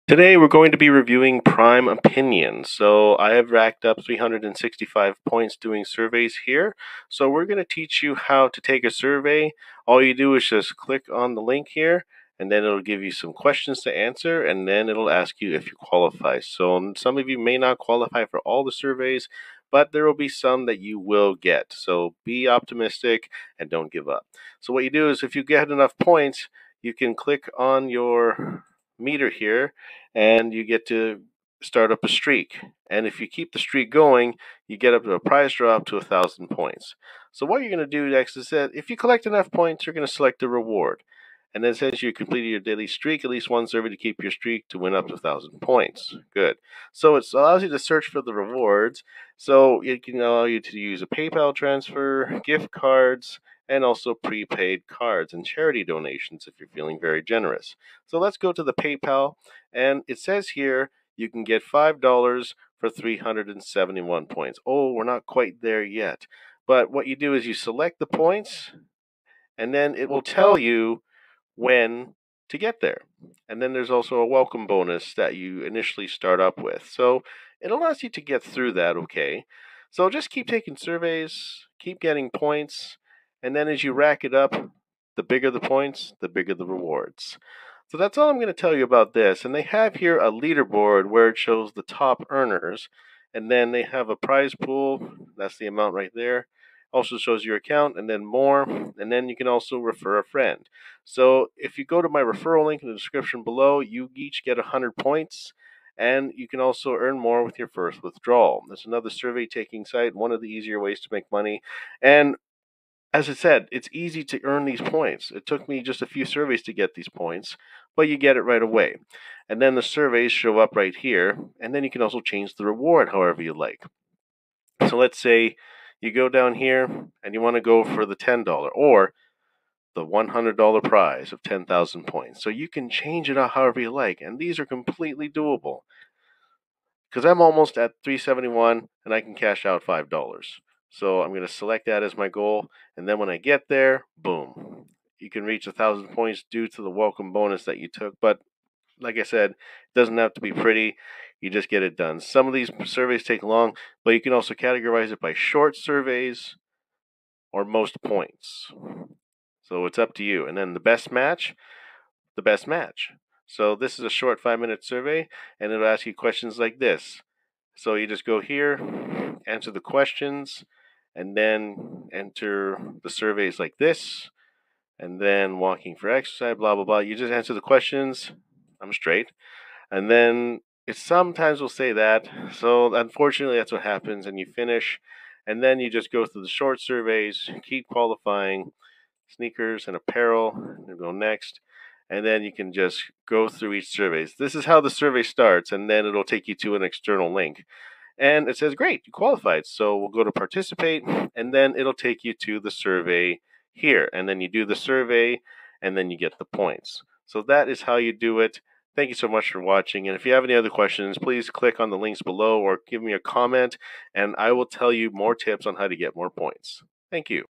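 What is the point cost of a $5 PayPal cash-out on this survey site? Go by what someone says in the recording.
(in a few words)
371.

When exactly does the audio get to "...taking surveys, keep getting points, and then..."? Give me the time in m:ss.
1:20.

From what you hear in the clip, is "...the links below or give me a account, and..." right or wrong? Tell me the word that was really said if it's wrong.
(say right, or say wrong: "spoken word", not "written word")
wrong: "comment", not "account".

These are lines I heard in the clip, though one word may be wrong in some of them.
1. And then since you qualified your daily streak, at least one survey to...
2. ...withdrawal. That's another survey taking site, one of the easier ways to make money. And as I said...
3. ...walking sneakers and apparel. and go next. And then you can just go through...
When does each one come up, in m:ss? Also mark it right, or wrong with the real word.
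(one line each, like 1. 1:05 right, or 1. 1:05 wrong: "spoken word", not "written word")
1. 0:41 wrong: "completed", not "qualified"
2. 1:48 right
3. 3:07 wrong: "qualifying", not "walking".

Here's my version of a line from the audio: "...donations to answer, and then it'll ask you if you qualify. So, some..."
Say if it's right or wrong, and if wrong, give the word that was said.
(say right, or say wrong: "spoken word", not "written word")
wrong: "questions", not "donations".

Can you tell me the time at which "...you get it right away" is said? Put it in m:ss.
1:58.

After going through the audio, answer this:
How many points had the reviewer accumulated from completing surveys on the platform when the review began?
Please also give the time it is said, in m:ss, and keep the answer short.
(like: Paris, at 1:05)
365, at 0:04.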